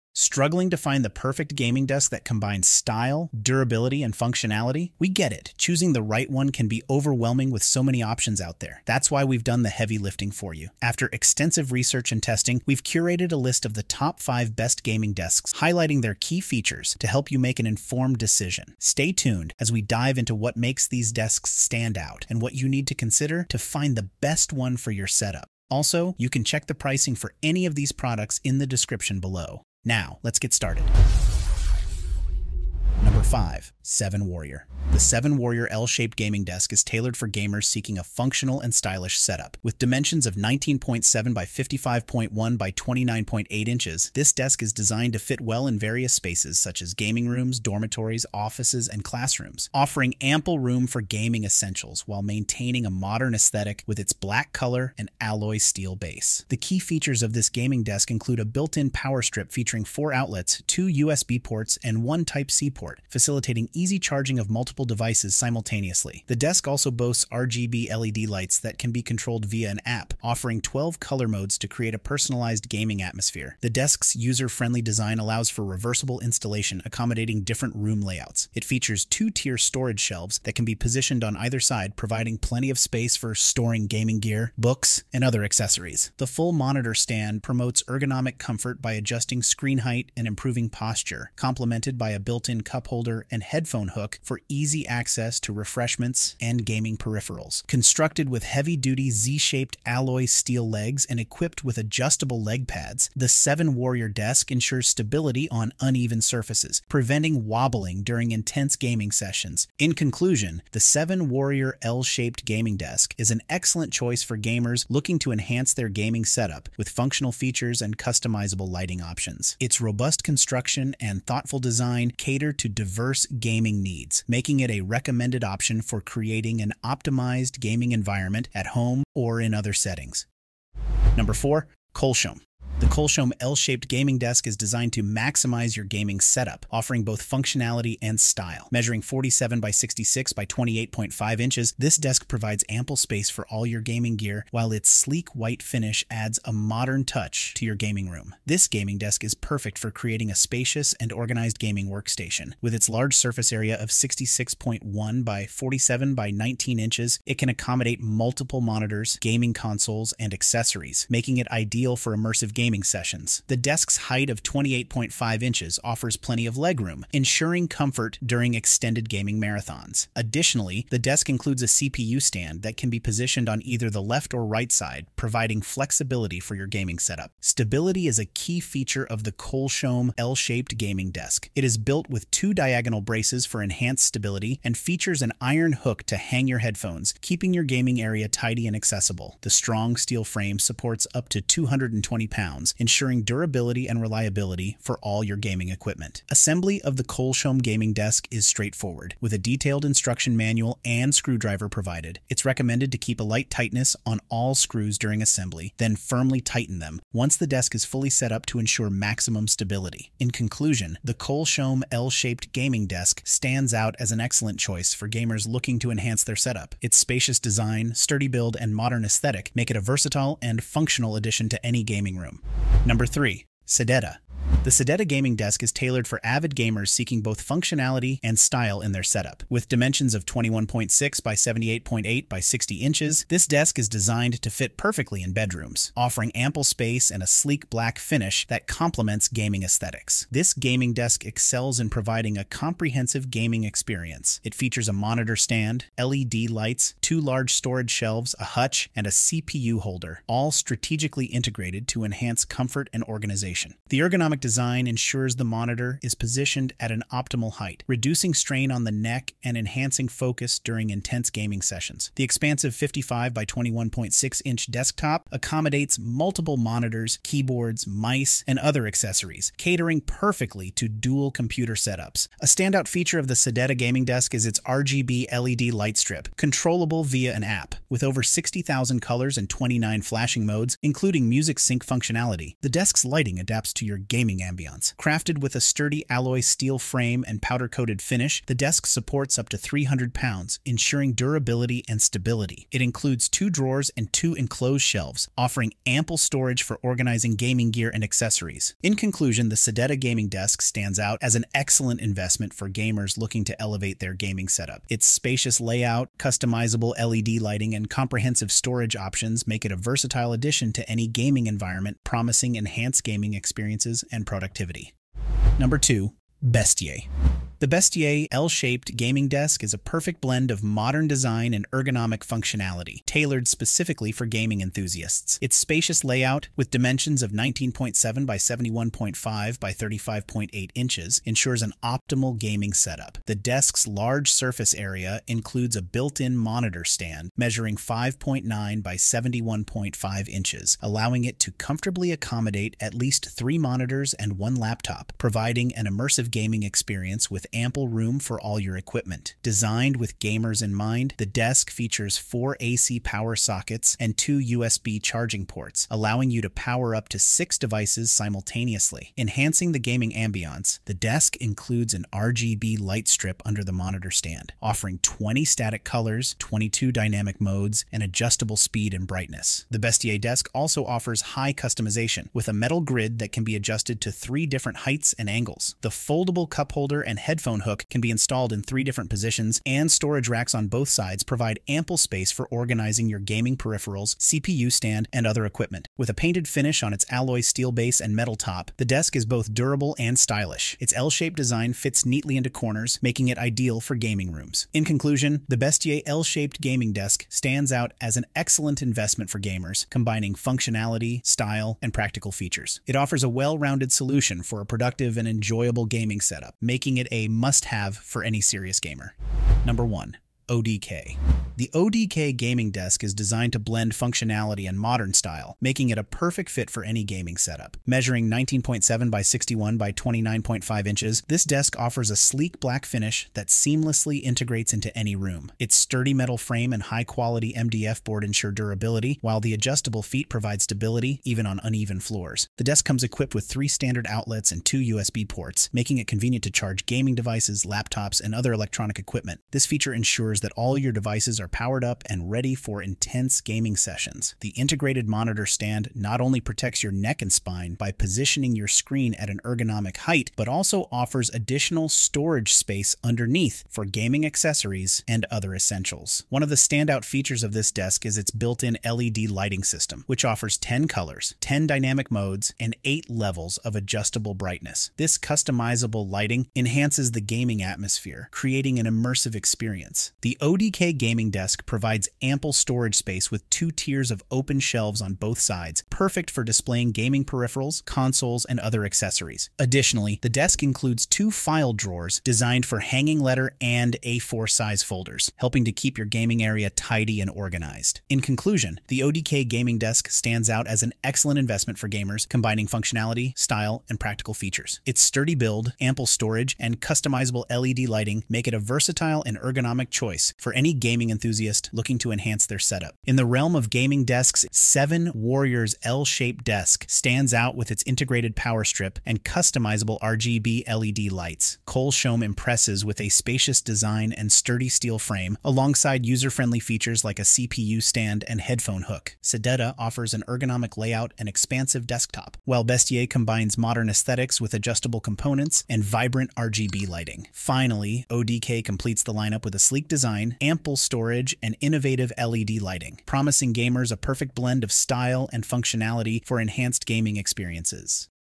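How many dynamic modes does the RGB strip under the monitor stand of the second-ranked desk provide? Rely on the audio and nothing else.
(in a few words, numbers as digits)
22.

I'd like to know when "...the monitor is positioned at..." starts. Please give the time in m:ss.
4:15.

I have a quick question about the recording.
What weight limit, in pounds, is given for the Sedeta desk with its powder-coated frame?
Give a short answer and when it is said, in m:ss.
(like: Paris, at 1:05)
300, at 4:49.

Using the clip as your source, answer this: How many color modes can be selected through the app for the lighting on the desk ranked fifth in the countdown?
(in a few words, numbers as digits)
12.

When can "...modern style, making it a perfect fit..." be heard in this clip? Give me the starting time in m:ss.
6:54.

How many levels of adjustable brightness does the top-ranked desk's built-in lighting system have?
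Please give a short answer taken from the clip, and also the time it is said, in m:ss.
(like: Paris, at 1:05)
8, at 7:42.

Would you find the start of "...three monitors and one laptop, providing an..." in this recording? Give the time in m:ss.
5:43.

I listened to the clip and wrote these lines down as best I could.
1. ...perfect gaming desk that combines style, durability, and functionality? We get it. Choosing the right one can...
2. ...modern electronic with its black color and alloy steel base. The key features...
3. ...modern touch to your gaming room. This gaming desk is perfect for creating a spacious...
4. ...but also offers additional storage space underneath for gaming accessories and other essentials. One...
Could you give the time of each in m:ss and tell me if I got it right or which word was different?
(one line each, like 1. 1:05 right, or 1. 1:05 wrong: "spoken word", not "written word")
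1. 0:01 right
2. 0:52 wrong: "aesthetic", not "electronic"
3. 2:26 right
4. 7:30 right.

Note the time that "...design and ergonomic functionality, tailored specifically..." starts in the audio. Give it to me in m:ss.
5:21.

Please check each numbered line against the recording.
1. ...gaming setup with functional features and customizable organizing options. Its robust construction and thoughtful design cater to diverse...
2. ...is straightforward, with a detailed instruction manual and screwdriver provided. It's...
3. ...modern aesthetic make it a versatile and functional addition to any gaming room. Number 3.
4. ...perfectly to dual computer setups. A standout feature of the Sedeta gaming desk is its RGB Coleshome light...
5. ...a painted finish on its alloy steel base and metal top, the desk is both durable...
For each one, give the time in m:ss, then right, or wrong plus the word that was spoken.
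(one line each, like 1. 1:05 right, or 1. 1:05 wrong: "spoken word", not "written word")
1. 1:55 wrong: "lighting", not "organizing"
2. 3:18 right
3. 3:38 right
4. 4:30 wrong: "LED", not "Coleshome"
5. 6:26 right.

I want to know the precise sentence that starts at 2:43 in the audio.
The desk's height of 28.5 inches offers plenty of legroom, ensuring comfort during extended gaming marathons.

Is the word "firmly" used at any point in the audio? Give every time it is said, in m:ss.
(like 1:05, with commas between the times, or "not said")
3:25.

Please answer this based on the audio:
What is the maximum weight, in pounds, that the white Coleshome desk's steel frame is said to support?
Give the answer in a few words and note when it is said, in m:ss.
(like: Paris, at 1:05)
220, at 3:11.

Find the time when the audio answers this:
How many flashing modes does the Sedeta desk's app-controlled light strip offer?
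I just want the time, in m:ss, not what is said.
4:39.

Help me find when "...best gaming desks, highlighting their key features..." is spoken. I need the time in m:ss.
0:14.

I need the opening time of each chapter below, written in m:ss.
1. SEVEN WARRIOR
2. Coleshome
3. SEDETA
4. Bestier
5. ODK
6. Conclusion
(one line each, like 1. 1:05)
1. 0:33
2. 2:12
3. 3:43
4. 5:16
5. 6:50
6. 8:24.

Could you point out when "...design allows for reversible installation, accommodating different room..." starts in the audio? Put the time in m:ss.
1:14.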